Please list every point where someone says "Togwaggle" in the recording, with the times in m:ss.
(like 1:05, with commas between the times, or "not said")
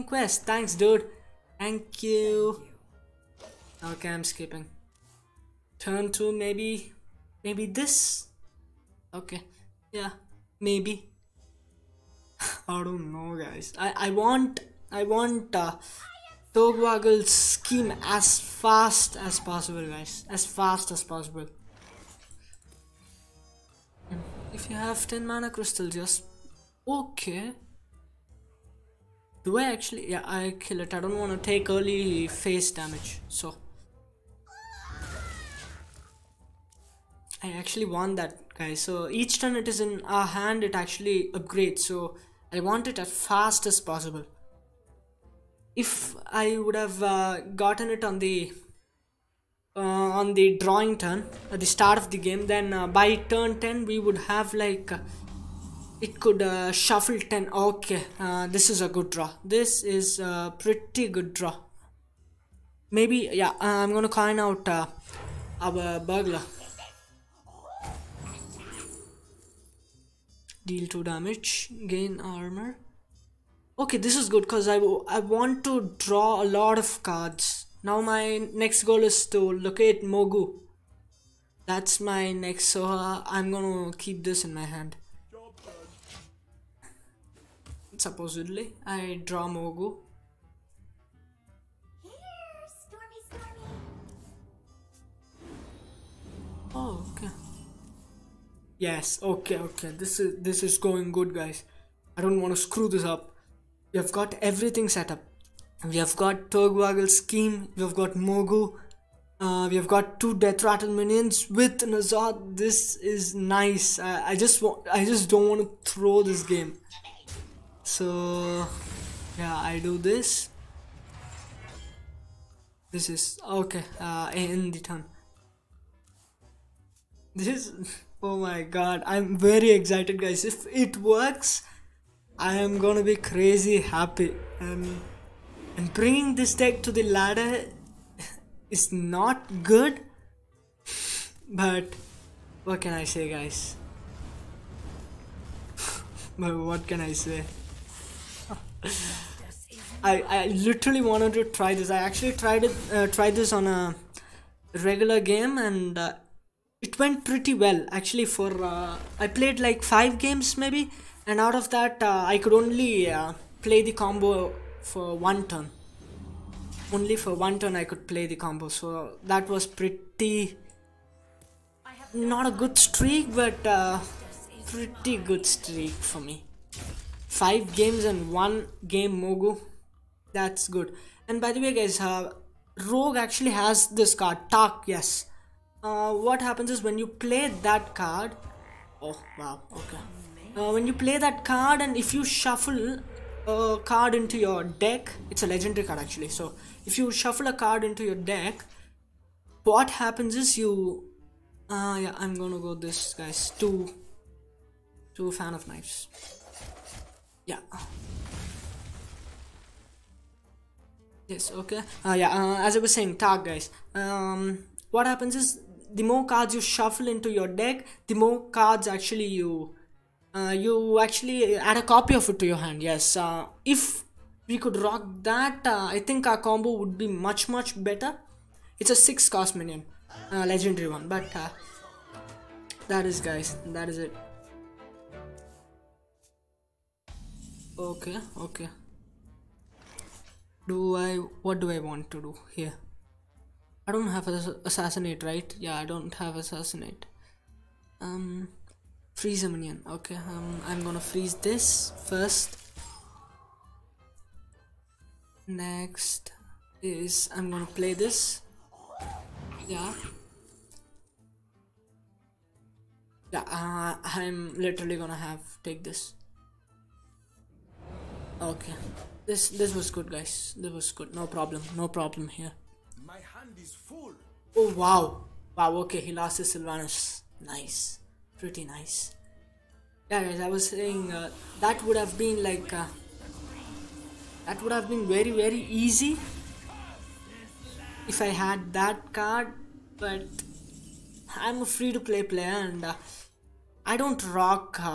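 0:16, 1:46.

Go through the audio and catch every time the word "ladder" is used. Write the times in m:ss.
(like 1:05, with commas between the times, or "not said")
2:17.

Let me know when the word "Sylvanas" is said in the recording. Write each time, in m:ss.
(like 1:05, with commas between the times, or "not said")
4:36.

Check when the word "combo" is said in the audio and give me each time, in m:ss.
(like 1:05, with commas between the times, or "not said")
2:43, 2:48, 3:46.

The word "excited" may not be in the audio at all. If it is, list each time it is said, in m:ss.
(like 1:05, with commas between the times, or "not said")
2:09.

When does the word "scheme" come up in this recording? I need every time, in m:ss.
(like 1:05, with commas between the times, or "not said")
0:17, 1:47.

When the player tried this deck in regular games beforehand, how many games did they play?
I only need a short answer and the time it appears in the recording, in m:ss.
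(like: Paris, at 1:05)
5, at 2:39.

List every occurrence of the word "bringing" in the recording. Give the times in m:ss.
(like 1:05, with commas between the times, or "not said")
2:15.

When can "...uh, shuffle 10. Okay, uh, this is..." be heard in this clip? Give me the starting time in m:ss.
0:56.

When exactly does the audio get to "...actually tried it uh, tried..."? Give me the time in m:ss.
2:31.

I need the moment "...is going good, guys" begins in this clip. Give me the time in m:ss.
1:40.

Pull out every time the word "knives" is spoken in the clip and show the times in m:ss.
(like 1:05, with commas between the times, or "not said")
3:25.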